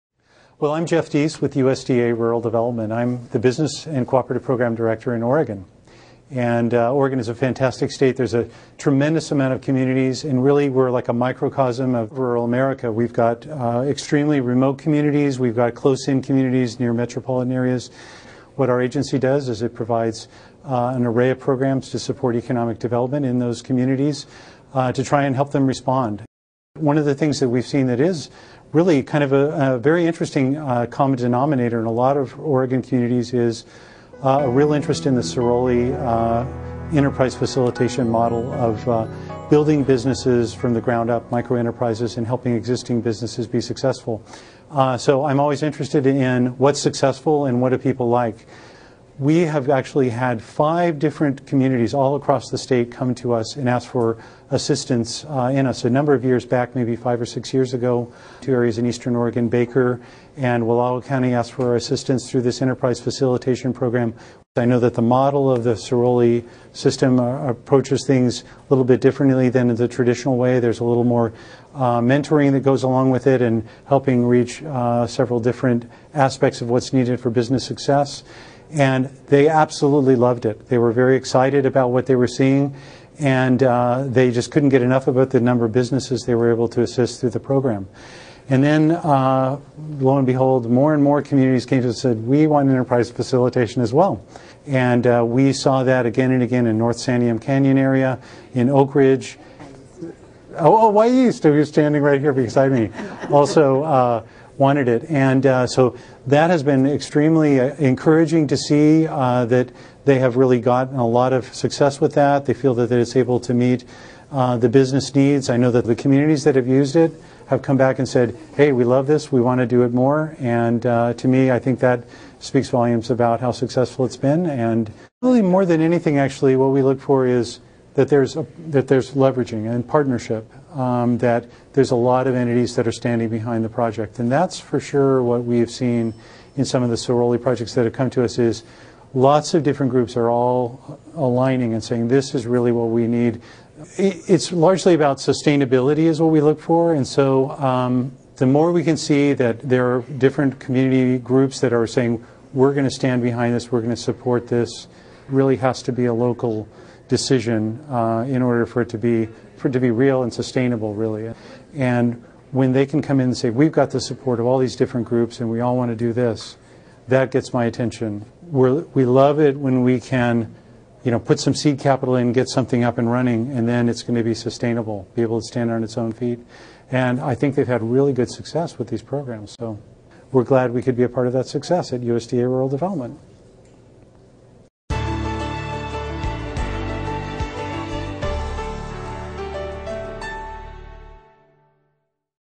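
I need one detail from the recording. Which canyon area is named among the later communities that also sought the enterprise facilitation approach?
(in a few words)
North Santiam Canyon.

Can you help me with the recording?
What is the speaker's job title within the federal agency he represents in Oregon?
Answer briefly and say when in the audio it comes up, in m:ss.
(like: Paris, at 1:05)
Business and Cooperative Program Director, at 0:03.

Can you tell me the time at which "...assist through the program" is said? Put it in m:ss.
1:26.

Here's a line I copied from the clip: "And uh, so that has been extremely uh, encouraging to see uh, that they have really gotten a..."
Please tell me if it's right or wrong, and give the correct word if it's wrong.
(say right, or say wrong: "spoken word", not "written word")
right.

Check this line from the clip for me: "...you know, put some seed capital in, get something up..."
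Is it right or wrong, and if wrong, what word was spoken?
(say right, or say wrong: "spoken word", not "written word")
right.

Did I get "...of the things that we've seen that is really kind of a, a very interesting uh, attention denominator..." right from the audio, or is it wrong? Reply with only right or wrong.
wrong.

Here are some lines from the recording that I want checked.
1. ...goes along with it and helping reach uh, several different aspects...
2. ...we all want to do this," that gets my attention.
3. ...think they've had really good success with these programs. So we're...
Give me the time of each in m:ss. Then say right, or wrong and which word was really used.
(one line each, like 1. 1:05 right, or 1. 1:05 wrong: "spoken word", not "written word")
1. 1:12 right
2. 2:45 right
3. 2:57 right.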